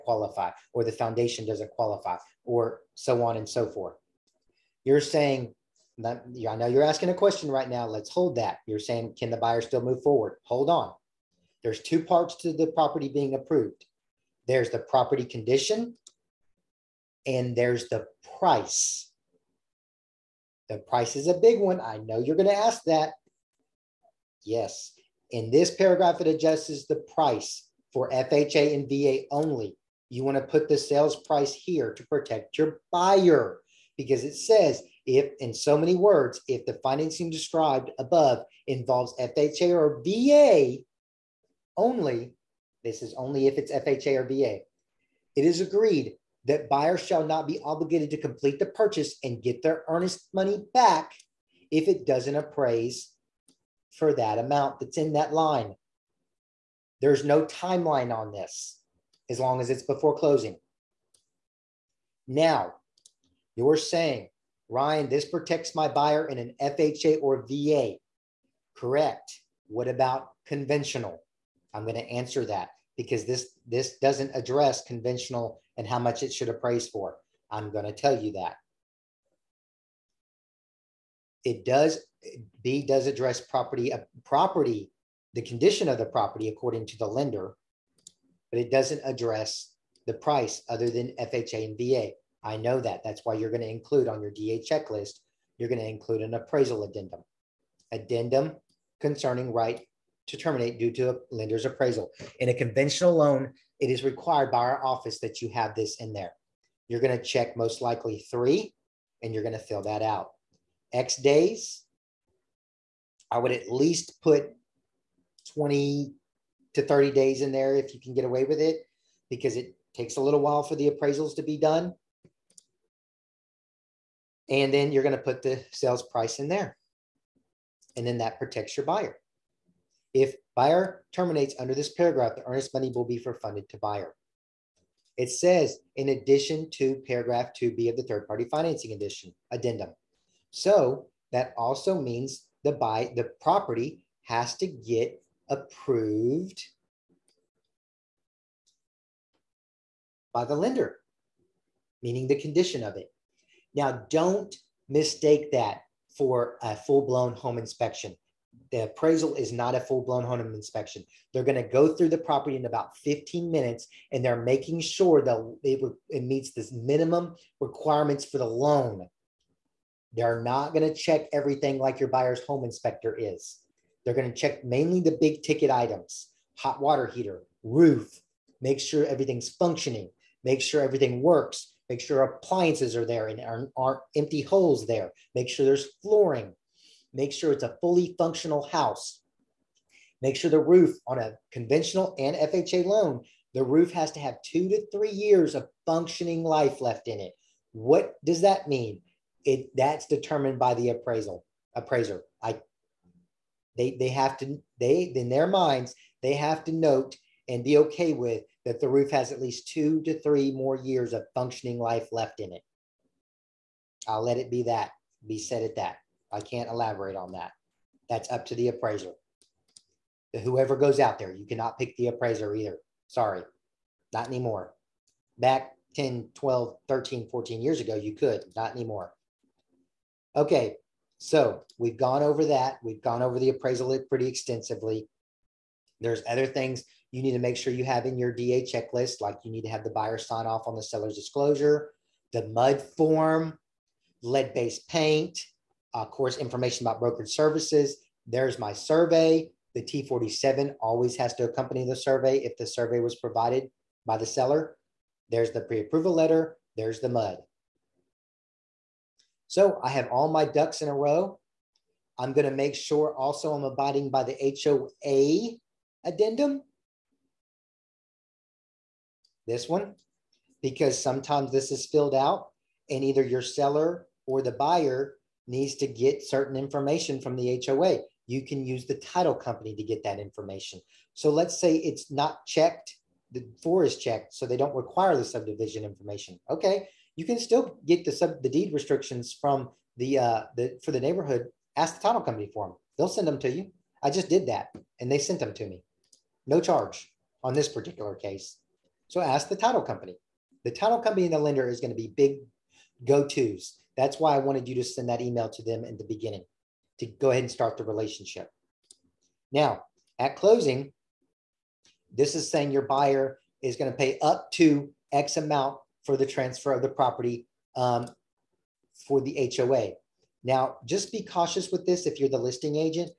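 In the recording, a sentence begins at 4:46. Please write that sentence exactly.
Okay, you can still get the sub the deed restrictions from the uh the for the neighborhood.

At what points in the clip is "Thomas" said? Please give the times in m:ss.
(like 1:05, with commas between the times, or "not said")
not said.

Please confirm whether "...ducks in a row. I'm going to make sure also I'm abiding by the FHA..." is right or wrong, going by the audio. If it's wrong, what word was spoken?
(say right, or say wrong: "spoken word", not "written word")
wrong: "HOA", not "FHA".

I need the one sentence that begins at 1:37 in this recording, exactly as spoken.
Addendum concerning right to terminate due to a lender's appraisal.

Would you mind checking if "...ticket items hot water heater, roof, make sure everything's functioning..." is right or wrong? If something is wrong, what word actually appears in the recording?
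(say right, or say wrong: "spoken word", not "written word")
right.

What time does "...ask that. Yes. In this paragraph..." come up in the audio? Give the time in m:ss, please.
0:22.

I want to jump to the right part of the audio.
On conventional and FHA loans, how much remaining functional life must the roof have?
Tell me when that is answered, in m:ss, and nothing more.
3:14.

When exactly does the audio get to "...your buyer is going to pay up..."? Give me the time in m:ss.
5:12.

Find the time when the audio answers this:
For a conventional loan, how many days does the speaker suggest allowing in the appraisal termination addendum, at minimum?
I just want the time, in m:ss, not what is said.
1:55.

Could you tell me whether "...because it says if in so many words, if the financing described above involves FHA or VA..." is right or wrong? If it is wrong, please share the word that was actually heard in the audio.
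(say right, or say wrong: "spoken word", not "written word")
right.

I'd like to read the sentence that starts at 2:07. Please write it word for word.
And then that protects your buyer.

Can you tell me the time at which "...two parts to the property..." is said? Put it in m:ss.
0:11.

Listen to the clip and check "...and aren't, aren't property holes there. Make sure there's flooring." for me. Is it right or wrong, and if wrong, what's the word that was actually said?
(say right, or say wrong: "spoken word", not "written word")
wrong: "empty", not "property".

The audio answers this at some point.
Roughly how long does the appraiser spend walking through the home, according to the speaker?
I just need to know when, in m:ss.
2:42.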